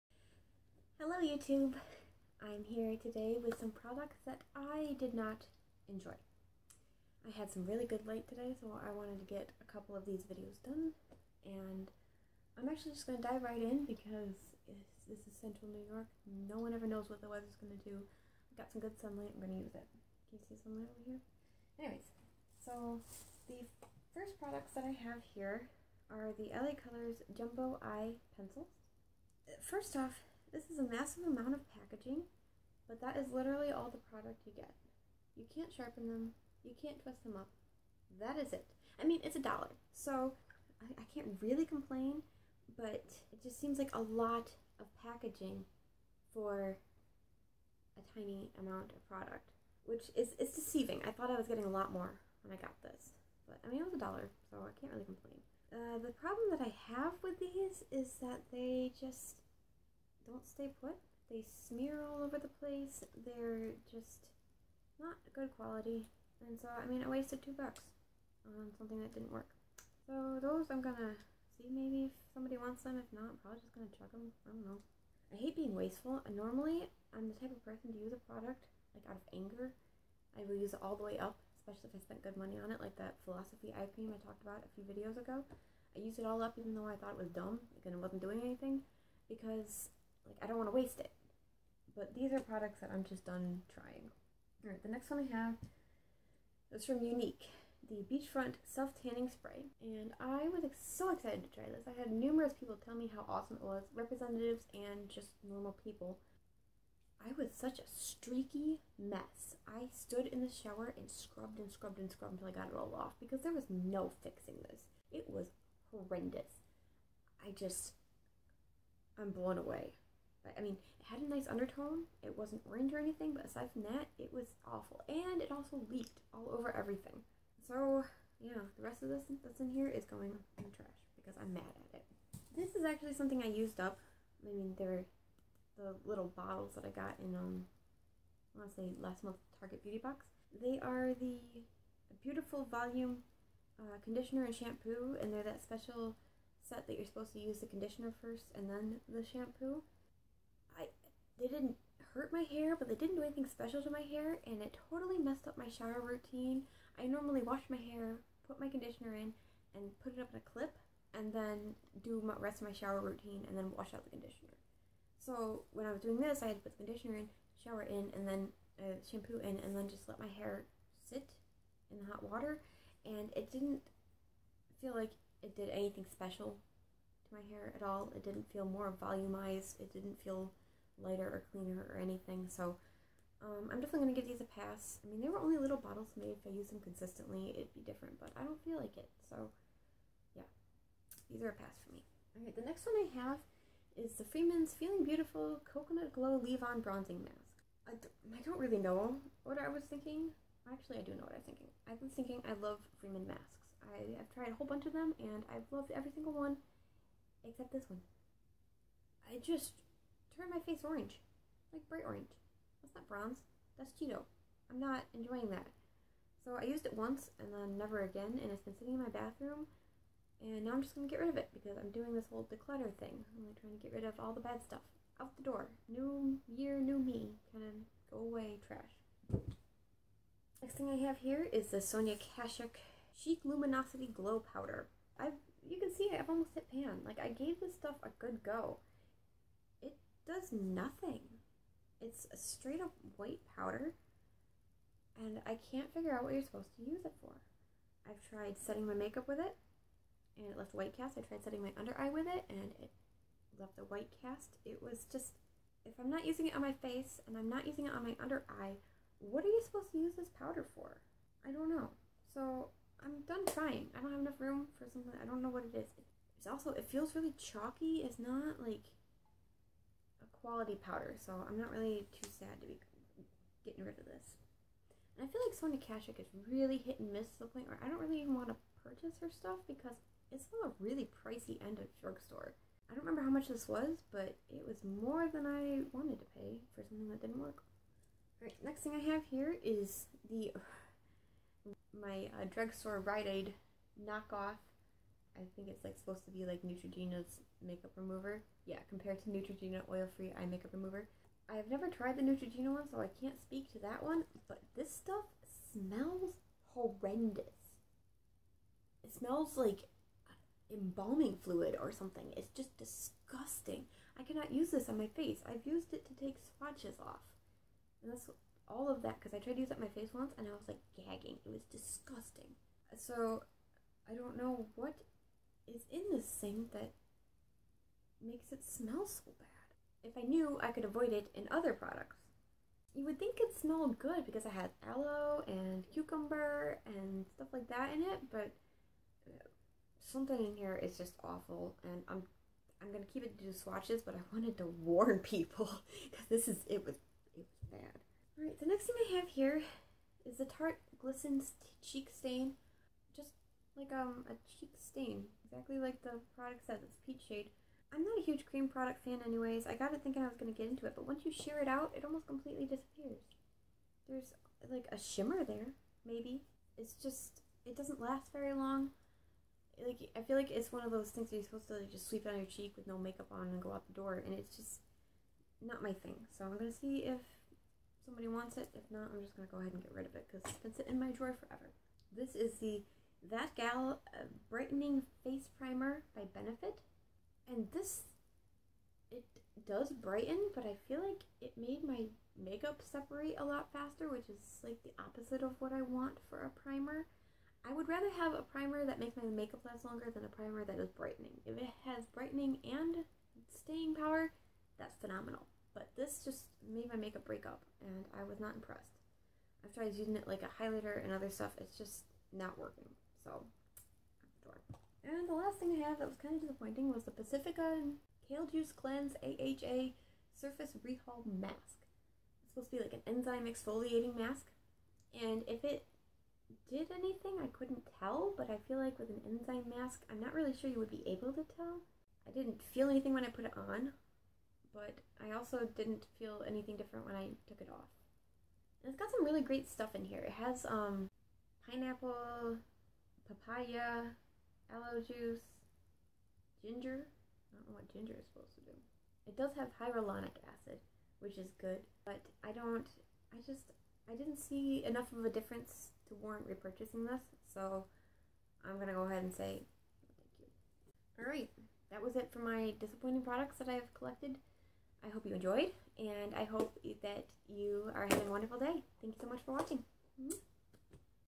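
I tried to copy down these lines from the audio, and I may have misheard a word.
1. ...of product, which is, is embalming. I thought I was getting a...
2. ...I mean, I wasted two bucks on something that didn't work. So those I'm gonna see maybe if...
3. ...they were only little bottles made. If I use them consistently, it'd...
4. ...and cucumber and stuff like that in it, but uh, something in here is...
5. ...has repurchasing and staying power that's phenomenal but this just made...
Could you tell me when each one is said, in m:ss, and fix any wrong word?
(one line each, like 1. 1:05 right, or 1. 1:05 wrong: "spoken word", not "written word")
1. 0:48 wrong: "deceiving", not "embalming"
2. 1:06 right
3. 3:05 right
4. 5:35 right
5. 6:41 wrong: "brightening", not "repurchasing".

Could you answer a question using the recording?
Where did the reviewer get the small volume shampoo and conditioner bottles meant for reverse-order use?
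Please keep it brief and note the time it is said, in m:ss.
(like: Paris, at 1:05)
Target Beauty Box, at 2:19.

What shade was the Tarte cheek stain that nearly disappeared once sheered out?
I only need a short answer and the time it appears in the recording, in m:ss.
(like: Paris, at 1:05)
Peach, at 5:57.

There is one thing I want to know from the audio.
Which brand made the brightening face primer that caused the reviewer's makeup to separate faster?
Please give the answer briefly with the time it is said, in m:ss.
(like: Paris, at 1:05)
Benefit, at 6:26.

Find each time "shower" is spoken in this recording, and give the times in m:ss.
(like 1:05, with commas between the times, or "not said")
1:50, 2:35, 2:42, 2:47.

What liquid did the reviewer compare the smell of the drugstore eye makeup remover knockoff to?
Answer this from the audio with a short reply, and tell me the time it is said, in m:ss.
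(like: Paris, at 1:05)
Embalming fluid, at 5:10.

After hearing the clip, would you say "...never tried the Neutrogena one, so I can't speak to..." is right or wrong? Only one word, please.
right.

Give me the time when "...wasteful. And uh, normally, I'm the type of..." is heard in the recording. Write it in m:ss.
1:15.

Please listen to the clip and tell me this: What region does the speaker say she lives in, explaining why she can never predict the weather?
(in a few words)
Central New York.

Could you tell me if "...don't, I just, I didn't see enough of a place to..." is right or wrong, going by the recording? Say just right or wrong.
wrong.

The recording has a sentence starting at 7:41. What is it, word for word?
Alright, that was it for my disappointing products that I have collected.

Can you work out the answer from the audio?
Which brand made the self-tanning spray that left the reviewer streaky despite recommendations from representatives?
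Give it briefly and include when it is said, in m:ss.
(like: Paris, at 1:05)
Younique, at 1:36.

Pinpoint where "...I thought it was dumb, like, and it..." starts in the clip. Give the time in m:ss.
1:26.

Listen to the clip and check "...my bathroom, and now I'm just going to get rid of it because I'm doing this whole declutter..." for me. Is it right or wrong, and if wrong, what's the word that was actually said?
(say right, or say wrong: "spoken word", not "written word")
right.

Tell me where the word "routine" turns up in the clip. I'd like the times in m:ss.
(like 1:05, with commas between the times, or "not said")
2:36, 2:43.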